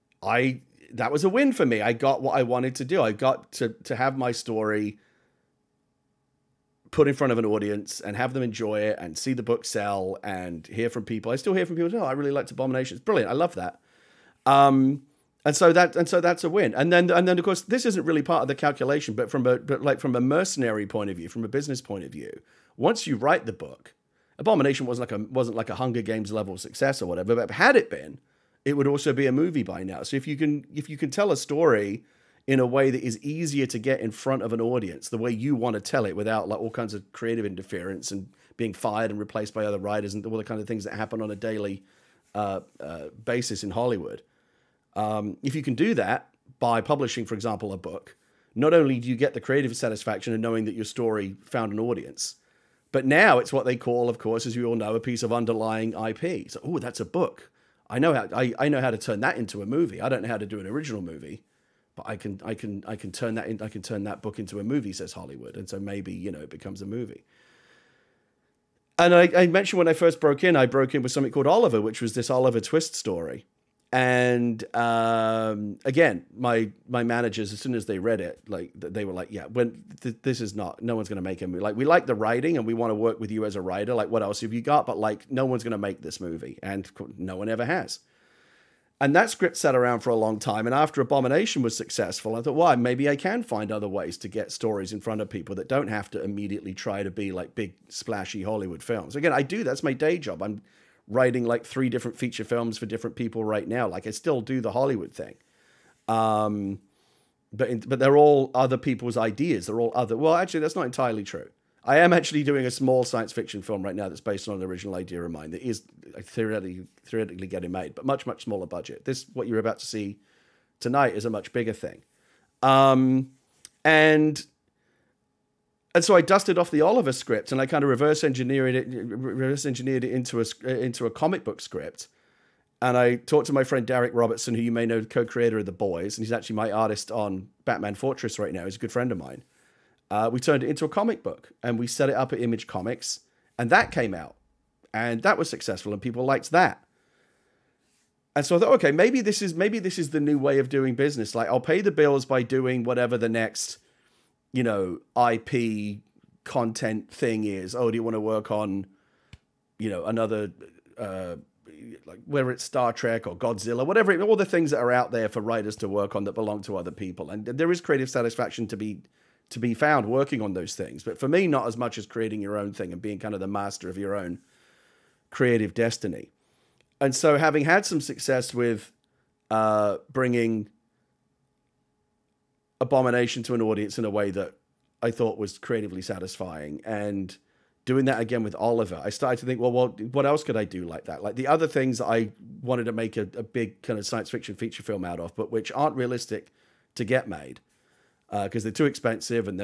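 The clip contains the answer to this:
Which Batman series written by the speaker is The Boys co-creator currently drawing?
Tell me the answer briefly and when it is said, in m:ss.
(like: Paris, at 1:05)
Batman Fortress, at 2:17.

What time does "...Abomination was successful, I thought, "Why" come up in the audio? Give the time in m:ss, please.
1:30.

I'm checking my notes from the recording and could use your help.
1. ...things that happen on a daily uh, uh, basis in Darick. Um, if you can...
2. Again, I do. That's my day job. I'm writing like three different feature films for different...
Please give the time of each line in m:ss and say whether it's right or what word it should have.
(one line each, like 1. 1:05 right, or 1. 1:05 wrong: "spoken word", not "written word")
1. 0:40 wrong: "Hollywood", not "Darick"
2. 1:39 right.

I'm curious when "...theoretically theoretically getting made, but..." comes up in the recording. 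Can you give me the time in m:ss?
1:56.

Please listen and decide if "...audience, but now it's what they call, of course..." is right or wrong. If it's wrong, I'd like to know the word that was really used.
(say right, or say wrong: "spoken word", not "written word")
right.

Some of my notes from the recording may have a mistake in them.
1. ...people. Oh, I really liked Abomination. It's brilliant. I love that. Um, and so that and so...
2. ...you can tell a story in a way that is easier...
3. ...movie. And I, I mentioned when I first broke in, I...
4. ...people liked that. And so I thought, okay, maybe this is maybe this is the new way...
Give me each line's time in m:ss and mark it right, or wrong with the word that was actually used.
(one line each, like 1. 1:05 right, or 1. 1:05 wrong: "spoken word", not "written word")
1. 0:11 right
2. 0:30 right
3. 1:06 right
4. 2:25 right.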